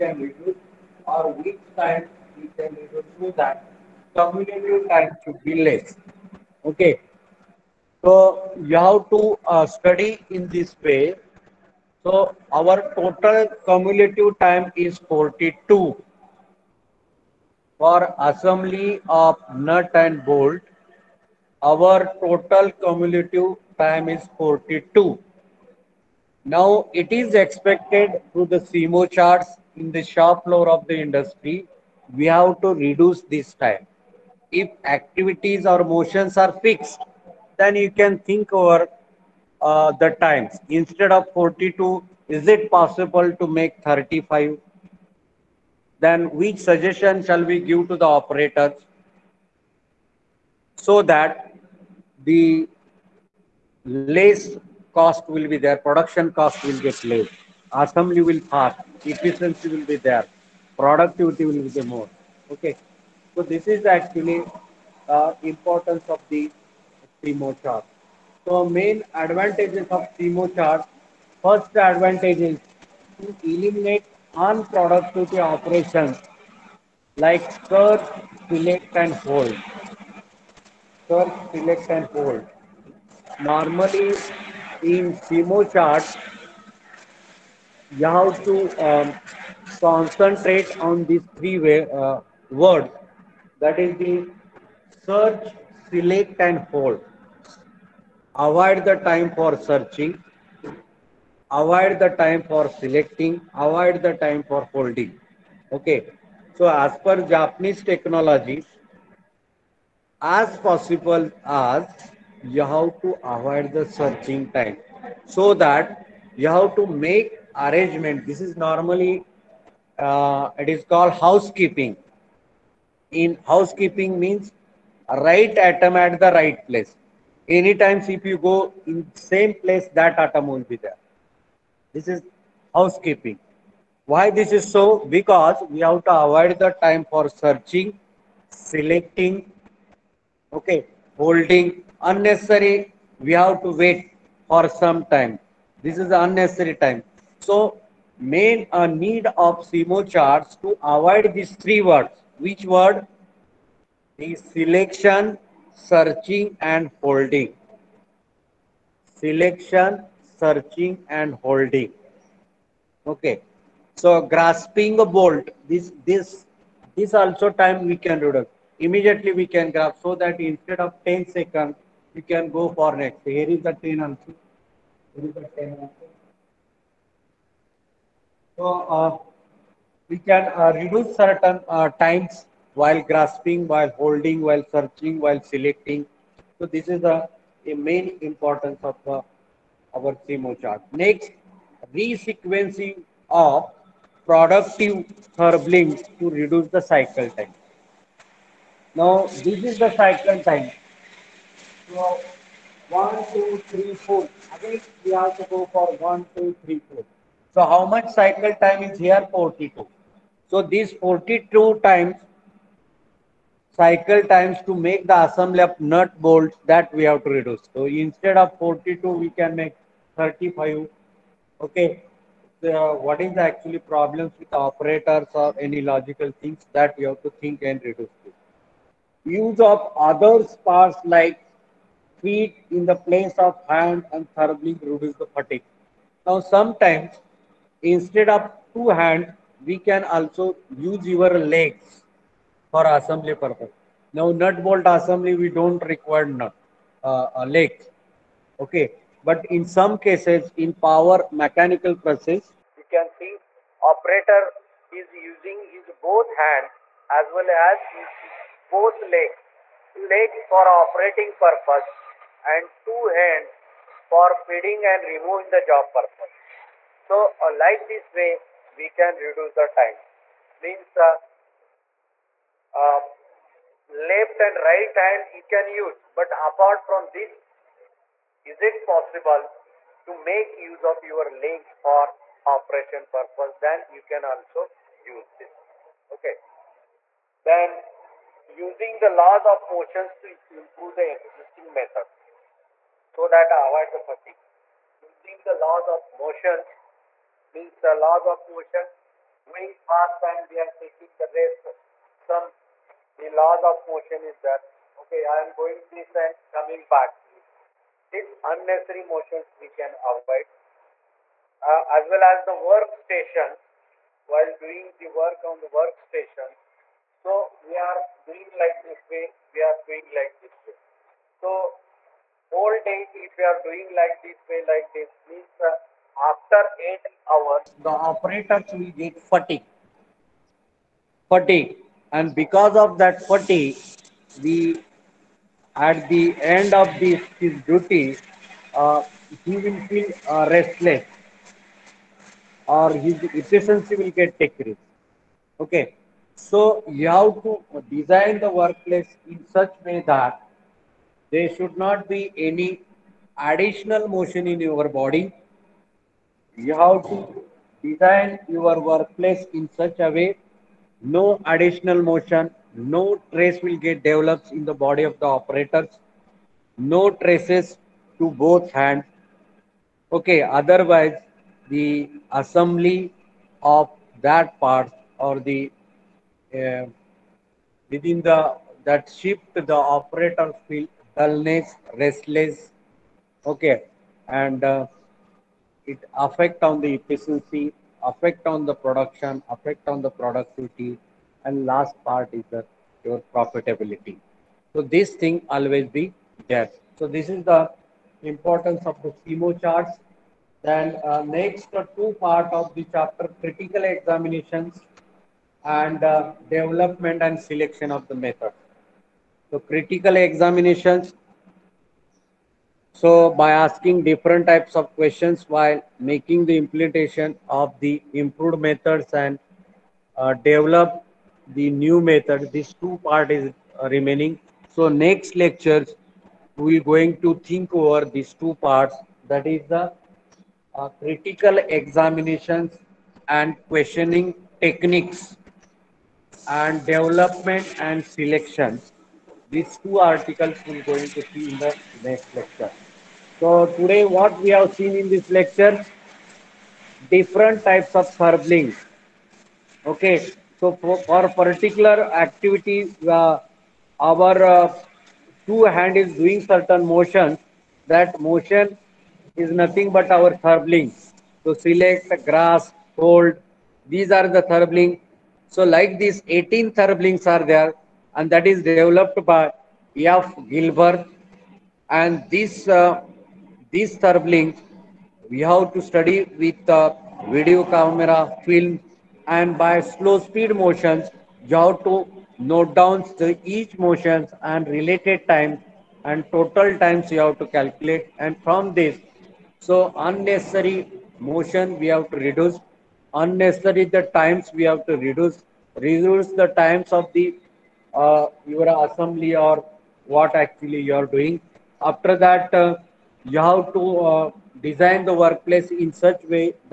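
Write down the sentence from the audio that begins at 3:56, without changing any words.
Now sometimes instead of two hands, we can also use your legs for assembly purpose.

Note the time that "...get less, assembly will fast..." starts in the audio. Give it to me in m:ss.
0:56.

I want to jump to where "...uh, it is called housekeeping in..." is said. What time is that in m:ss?
1:59.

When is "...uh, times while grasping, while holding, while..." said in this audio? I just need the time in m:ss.
3:01.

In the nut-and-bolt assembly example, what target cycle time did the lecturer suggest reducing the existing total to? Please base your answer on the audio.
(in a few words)
35.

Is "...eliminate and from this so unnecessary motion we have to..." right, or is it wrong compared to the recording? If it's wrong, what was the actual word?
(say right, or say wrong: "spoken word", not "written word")
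wrong: "calculate", not "eliminate".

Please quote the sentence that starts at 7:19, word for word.
These two articles we're going to see in the next lecture.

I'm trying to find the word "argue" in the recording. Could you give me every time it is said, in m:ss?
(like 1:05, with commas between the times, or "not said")
not said.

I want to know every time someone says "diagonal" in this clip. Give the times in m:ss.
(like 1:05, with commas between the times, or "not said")
not said.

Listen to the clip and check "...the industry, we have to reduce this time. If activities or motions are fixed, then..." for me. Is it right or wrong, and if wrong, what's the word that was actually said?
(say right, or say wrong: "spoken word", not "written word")
right.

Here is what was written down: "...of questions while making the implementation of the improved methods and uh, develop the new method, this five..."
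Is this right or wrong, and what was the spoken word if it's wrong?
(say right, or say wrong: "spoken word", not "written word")
wrong: "two", not "five".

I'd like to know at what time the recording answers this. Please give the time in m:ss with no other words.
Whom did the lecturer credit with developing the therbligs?
7:49.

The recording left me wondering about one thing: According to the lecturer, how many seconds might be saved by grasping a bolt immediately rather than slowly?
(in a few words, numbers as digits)
10.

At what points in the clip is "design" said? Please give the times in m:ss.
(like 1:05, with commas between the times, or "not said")
5:47, 5:57, 8:24.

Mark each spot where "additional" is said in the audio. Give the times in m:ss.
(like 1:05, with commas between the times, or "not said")
5:53, 6:01.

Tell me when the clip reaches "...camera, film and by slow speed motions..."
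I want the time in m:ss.
7:57.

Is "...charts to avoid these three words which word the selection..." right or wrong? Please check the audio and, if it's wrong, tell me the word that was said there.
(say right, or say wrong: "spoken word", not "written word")
right.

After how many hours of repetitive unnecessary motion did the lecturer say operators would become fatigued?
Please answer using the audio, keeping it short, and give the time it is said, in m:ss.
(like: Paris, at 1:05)
8, at 5:26.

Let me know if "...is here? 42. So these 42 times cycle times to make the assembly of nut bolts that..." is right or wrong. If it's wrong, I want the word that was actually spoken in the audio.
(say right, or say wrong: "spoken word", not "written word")
right.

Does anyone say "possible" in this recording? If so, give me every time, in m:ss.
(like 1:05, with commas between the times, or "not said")
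0:42, 1:50, 4:38.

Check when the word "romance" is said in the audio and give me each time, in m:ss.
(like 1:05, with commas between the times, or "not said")
not said.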